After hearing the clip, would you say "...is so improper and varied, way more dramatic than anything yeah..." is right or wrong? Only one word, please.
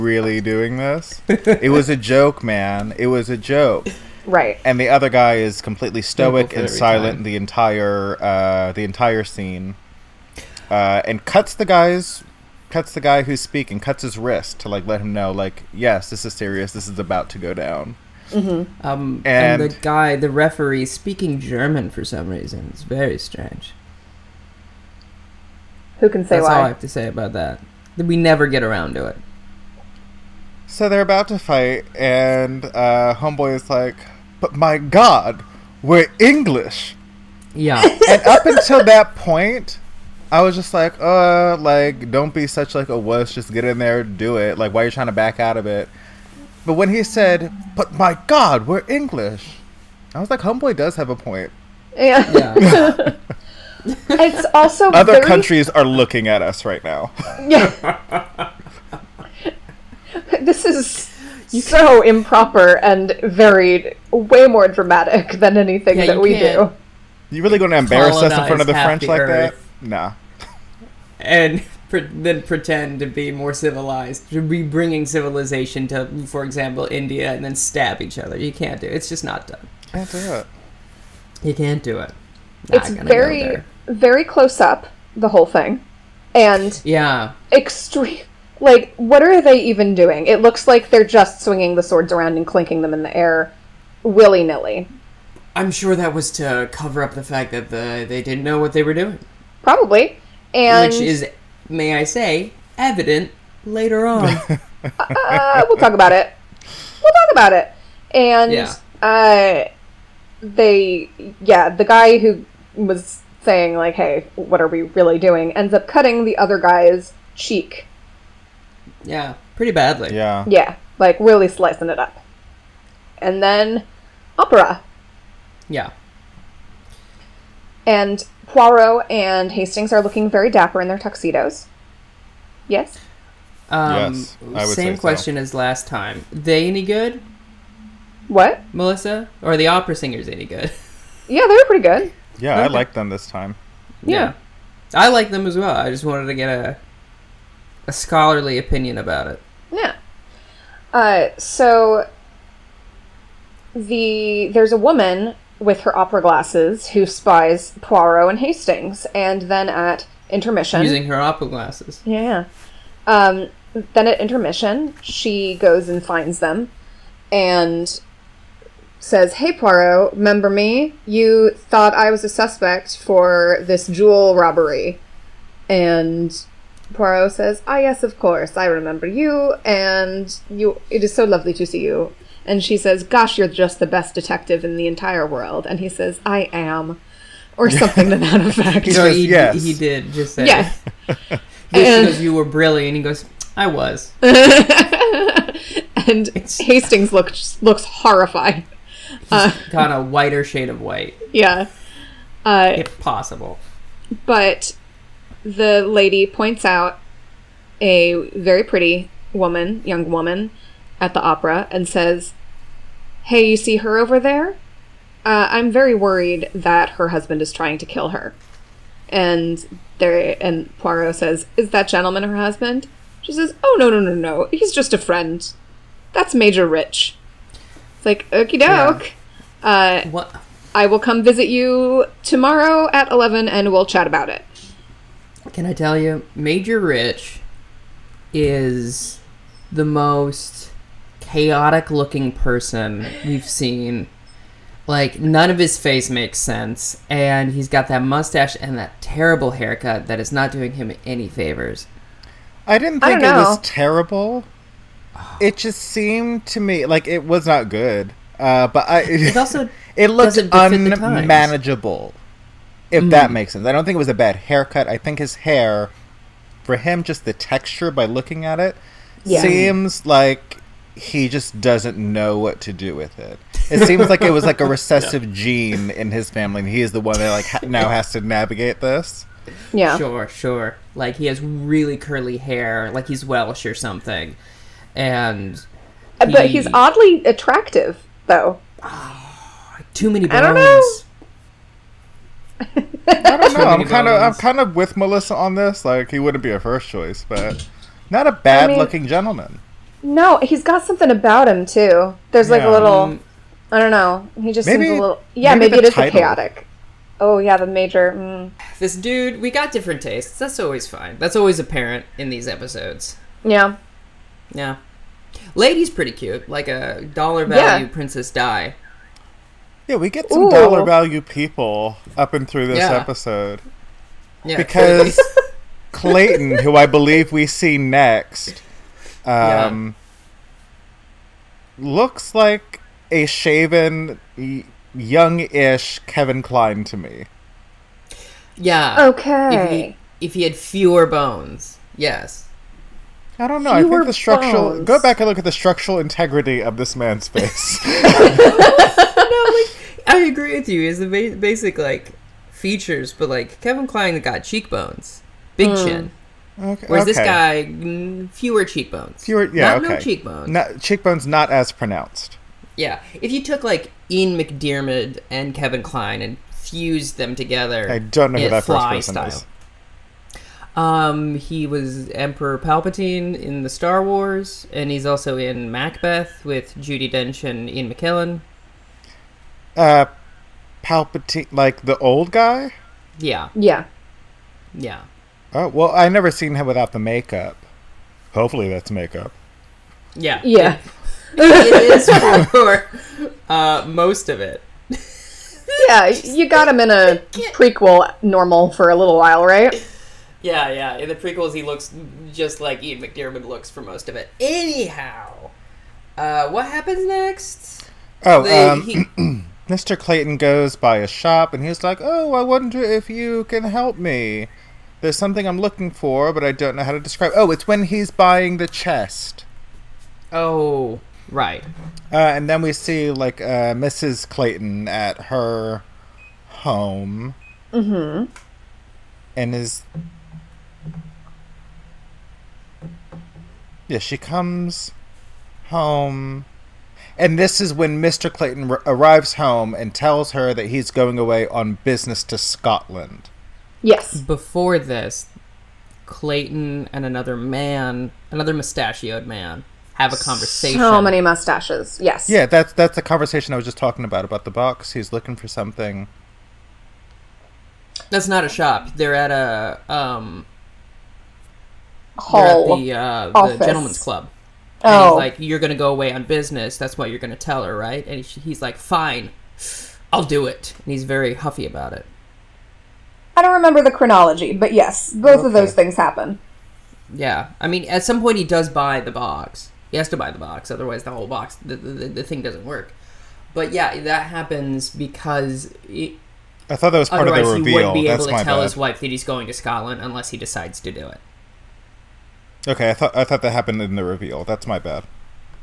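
right.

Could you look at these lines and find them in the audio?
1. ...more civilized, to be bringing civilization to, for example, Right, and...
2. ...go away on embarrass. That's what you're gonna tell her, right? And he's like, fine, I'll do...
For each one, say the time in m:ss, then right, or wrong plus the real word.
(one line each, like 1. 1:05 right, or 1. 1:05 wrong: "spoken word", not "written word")
1. 1:13 wrong: "India", not "Right"
2. 7:45 wrong: "business", not "embarrass".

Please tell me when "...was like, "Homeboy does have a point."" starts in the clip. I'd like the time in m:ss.
0:50.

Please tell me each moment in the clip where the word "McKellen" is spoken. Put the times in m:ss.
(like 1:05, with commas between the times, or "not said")
6:17.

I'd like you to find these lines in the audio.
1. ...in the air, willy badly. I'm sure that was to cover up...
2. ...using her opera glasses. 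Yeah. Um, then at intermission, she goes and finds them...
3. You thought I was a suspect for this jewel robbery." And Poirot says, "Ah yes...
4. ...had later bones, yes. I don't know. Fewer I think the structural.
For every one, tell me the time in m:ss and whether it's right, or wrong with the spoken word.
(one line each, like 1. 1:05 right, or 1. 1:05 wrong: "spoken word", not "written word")
1. 1:32 wrong: "nilly", not "badly"
2. 2:40 right
3. 2:51 right
4. 5:40 wrong: "fewer", not "later".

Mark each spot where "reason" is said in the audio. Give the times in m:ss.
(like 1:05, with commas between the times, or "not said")
0:22.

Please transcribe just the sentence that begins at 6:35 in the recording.
yeah, you got him in a prequel normal for a little while, right?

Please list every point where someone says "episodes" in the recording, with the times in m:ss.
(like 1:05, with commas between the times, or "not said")
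5:12, 5:22.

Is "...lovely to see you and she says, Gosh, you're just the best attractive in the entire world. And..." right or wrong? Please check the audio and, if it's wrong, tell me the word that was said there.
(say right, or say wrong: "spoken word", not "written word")
wrong: "detective", not "attractive".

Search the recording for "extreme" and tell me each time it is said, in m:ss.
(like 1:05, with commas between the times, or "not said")
1:27.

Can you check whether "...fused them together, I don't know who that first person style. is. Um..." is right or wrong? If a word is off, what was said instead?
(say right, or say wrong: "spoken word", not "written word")
right.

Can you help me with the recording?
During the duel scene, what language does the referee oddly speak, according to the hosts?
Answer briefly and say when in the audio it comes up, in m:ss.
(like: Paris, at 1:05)
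German, at 0:20.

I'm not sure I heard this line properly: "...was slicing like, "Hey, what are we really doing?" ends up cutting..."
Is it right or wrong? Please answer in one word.
wrong.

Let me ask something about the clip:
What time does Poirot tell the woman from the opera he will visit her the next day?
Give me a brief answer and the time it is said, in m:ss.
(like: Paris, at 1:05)
11, at 3:53.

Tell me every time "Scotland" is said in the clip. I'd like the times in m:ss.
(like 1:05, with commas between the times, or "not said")
7:22, 8:09.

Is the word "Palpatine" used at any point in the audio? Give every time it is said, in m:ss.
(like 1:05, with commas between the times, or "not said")
6:12, 6:20.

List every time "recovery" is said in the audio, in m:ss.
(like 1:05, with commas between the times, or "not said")
not said.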